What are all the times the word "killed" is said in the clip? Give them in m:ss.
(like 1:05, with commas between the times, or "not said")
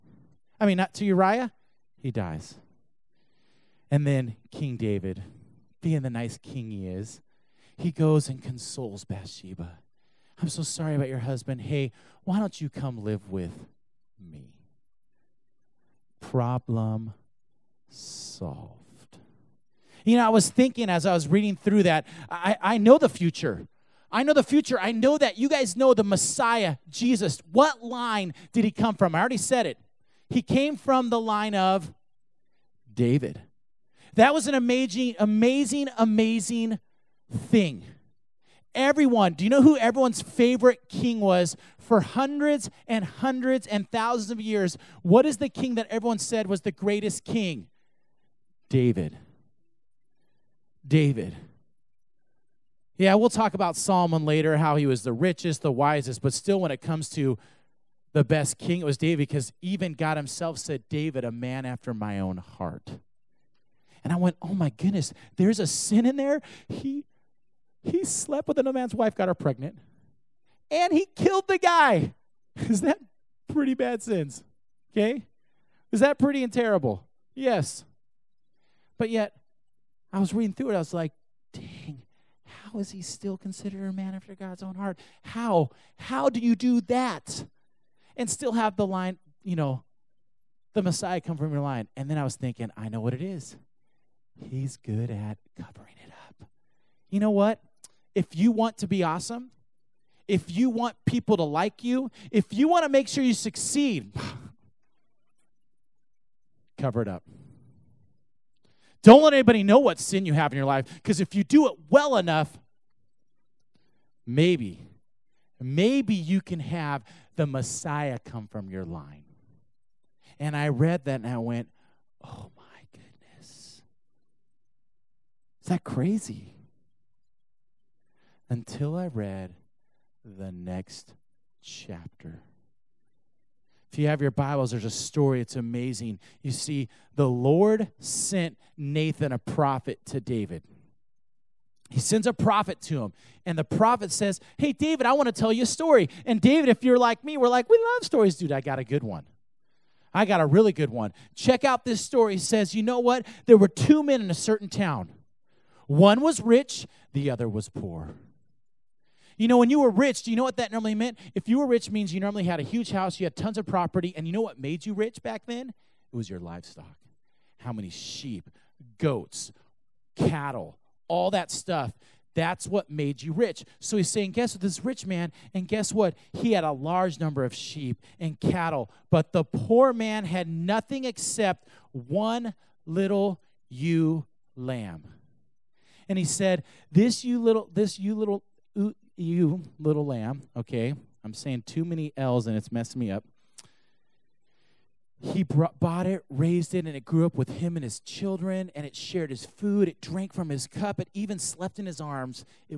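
1:11.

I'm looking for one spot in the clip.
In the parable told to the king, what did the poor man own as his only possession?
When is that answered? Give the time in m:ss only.
3:01.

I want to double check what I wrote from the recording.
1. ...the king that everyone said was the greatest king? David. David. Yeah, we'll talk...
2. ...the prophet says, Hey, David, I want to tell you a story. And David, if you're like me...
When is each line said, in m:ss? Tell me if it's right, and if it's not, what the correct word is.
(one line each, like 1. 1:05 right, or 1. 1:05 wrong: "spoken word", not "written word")
1. 0:45 right
2. 2:23 right.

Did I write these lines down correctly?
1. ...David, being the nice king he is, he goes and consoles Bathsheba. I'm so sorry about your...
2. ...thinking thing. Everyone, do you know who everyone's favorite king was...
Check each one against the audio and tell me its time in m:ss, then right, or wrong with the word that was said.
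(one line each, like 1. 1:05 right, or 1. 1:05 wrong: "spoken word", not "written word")
1. 0:04 right
2. 0:35 wrong: "amazing", not "thinking".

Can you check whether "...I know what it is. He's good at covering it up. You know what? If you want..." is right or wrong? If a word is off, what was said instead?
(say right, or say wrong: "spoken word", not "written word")
right.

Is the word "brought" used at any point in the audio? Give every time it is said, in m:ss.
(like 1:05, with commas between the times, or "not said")
3:15.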